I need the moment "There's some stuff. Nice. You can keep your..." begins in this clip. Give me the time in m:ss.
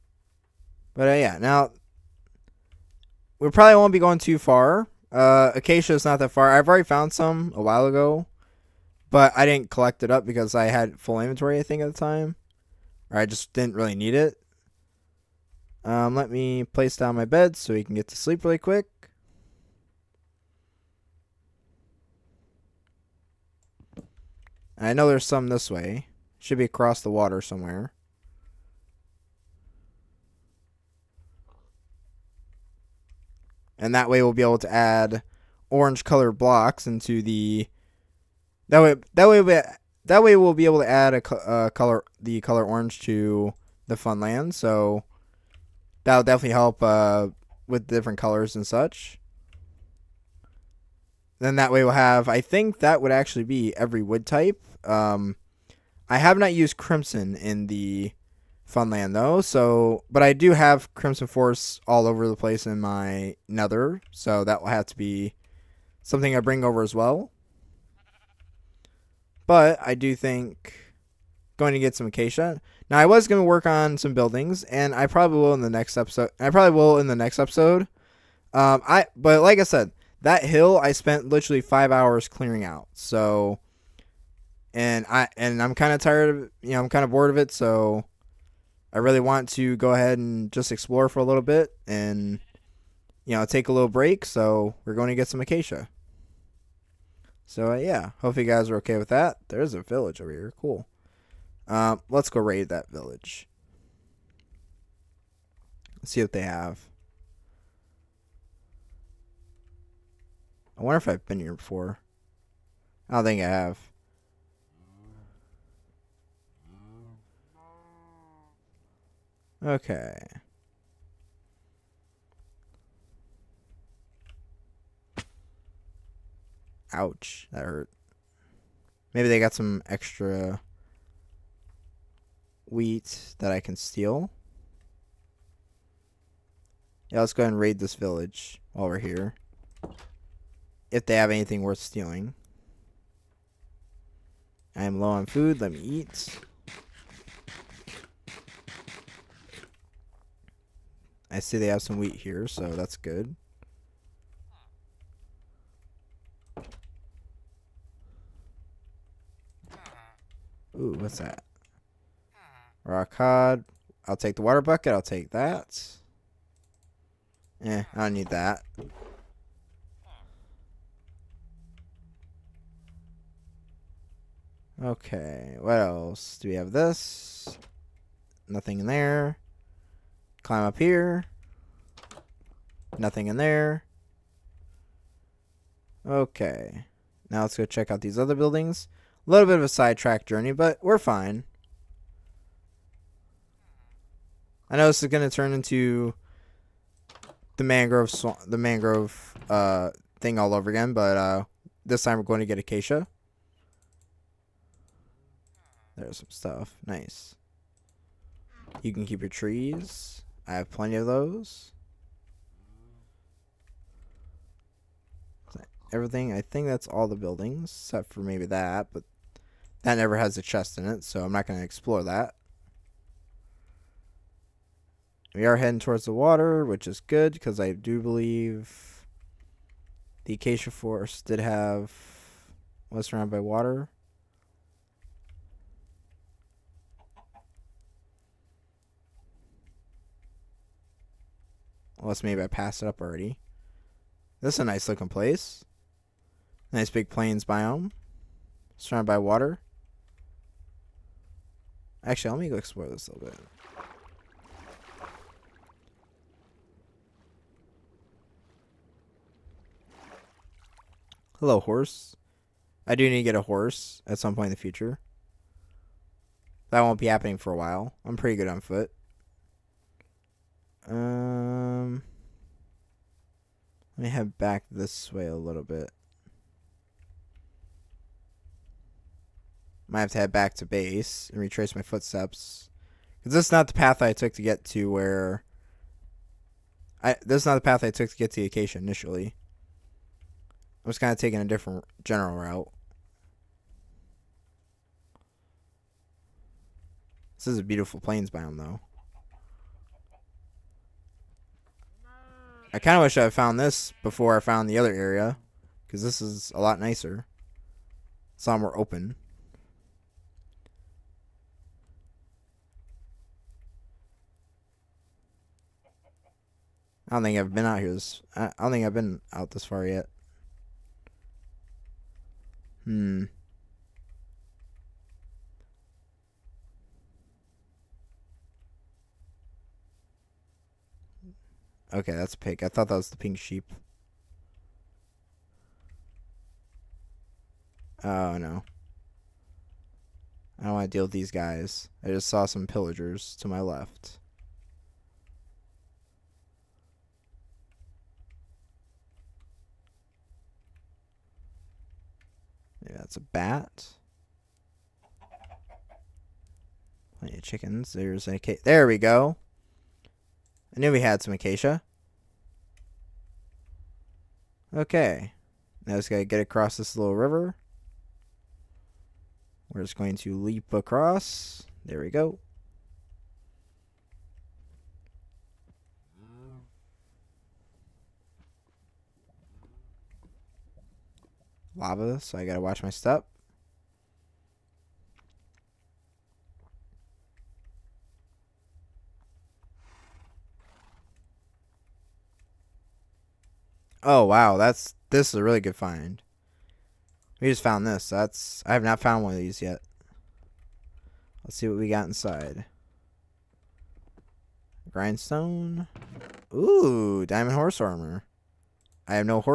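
3:25.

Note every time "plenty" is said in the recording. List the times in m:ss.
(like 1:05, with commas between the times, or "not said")
3:30, 5:57.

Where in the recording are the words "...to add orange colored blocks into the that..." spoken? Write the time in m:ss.
0:34.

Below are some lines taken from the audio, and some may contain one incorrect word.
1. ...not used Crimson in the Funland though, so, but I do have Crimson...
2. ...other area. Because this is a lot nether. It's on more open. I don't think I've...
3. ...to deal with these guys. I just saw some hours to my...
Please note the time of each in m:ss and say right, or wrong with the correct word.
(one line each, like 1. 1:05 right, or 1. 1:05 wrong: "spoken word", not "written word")
1. 0:56 right
2. 5:04 wrong: "nicer", not "nether"
3. 5:40 wrong: "pillagers", not "hours".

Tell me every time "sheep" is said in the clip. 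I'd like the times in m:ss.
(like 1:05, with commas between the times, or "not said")
5:33.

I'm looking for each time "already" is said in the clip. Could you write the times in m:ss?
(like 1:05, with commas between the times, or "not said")
0:06, 4:02.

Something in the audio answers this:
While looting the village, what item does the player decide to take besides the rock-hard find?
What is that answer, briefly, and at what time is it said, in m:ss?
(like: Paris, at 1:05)
Water bucket, at 2:44.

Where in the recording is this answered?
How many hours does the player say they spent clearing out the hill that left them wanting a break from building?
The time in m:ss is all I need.
1:21.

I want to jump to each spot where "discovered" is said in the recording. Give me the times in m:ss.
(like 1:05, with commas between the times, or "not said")
not said.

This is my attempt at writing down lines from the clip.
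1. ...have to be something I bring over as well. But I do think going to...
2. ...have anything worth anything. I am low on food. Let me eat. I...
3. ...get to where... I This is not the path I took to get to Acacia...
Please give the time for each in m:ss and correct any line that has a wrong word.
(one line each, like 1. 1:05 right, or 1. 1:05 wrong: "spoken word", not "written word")
1. 1:04 right
2. 2:21 wrong: "stealing", not "anything"
3. 4:44 right.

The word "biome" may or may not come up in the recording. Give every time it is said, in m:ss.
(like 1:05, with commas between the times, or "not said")
4:07, 4:58.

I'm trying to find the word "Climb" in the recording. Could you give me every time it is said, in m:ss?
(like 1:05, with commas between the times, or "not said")
3:00.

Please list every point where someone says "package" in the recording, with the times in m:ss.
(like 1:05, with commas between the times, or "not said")
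not said.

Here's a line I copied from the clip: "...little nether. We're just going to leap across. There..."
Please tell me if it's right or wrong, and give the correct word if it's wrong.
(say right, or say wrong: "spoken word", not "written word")
wrong: "river", not "nether".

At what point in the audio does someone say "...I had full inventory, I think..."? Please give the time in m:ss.
0:10.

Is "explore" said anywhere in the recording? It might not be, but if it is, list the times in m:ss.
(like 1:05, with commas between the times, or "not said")
1:30, 3:41, 4:12.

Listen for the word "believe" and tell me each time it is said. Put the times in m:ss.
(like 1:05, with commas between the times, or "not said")
3:47.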